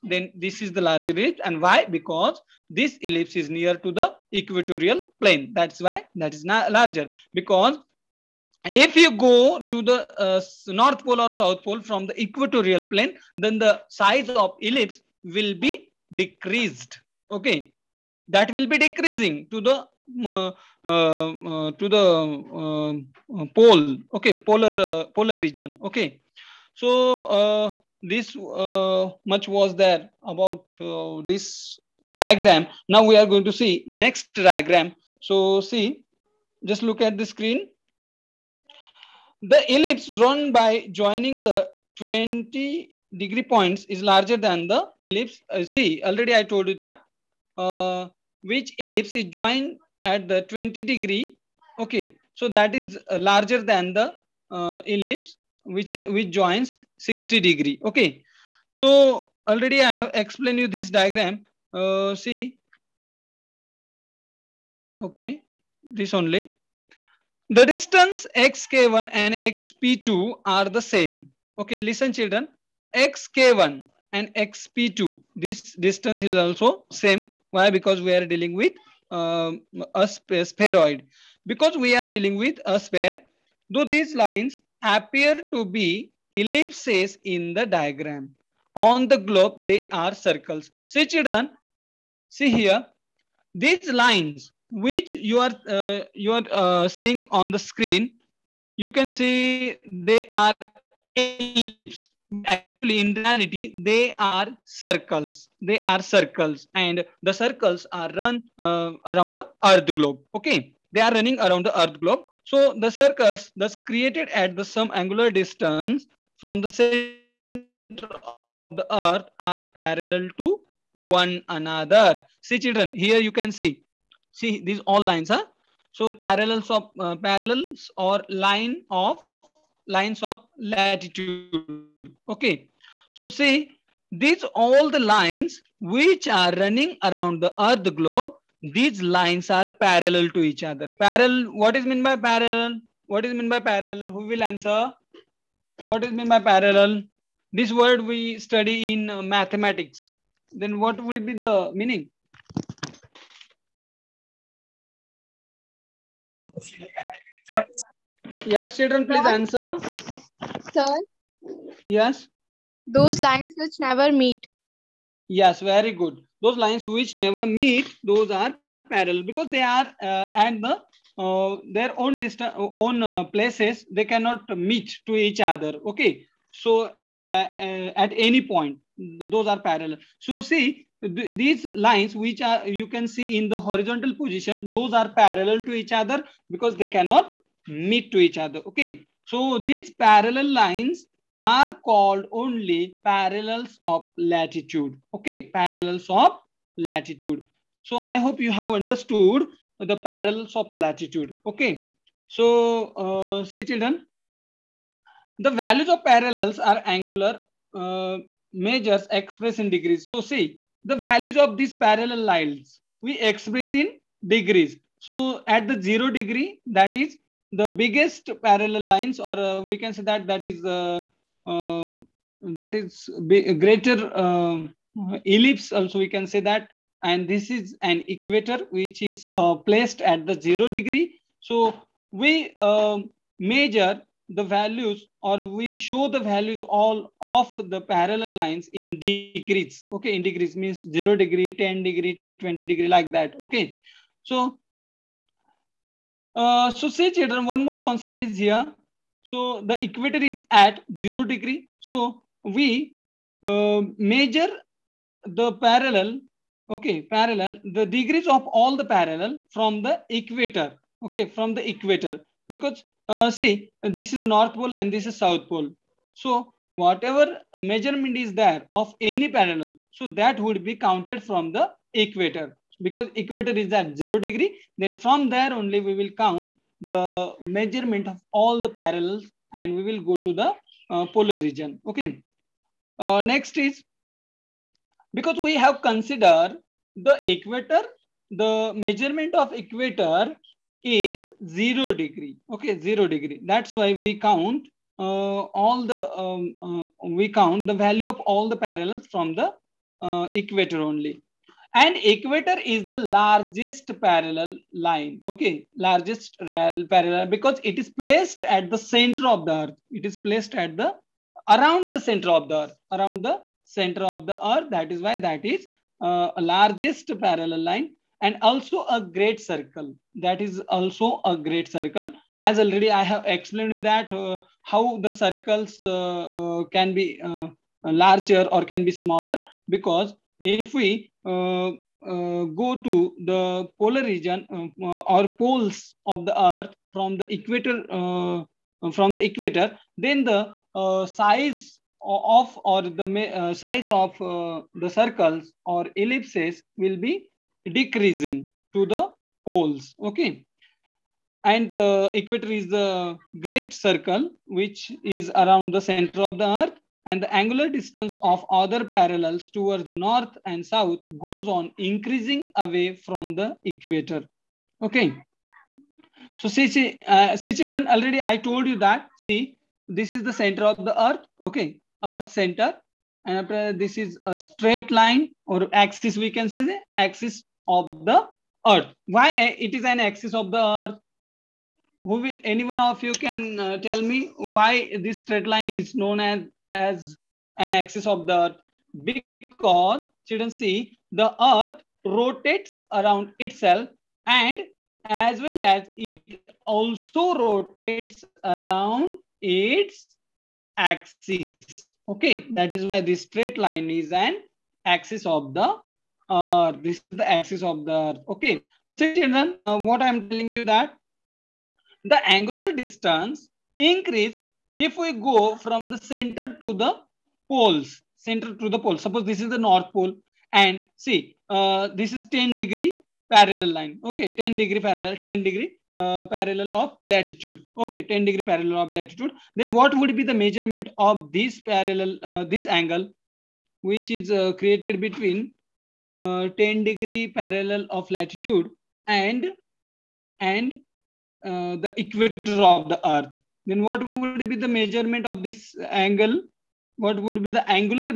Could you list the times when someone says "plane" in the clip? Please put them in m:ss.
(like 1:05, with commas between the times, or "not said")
0:05, 0:12.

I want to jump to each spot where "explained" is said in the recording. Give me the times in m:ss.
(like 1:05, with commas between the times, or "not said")
1:00, 5:23.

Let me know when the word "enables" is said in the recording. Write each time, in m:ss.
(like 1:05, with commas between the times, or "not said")
not said.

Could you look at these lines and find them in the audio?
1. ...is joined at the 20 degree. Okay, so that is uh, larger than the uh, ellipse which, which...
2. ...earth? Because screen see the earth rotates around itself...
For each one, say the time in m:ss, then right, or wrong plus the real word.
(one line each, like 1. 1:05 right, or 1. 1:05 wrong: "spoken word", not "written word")
1. 0:49 right
2. 6:29 wrong: "children", not "screen".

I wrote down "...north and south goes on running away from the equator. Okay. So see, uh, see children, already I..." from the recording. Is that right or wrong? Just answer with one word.
wrong.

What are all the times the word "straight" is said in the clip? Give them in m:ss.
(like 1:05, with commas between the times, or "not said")
6:14, 6:25, 6:43.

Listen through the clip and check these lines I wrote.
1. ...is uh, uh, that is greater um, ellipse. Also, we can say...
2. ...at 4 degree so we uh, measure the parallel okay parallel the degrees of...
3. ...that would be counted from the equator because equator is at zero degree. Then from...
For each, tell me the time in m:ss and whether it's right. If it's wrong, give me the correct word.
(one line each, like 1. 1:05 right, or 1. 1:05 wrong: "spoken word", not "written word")
1. 3:40 right
2. 4:10 wrong: "0", not "4"
3. 4:30 right.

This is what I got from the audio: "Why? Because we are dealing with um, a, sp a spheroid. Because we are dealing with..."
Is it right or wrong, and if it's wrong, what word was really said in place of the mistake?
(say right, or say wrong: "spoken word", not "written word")
right.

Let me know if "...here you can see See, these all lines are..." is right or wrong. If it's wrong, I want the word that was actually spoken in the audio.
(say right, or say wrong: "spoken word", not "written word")
right.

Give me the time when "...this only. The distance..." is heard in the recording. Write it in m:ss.
1:05.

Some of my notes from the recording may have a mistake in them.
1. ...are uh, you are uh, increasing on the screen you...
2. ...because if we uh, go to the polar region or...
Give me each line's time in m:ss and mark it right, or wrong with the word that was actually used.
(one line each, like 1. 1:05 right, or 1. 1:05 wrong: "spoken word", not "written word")
1. 1:35 wrong: "seeing", not "increasing"
2. 5:29 right.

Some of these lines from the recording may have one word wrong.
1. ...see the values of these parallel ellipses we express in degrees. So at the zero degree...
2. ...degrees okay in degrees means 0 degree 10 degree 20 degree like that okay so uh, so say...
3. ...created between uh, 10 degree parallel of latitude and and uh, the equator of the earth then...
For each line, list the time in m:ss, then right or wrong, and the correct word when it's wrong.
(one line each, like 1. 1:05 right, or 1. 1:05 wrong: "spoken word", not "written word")
1. 3:30 wrong: "lines", not "ellipses"
2. 3:59 right
3. 7:14 right.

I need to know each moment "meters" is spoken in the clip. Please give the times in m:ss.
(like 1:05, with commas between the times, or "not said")
not said.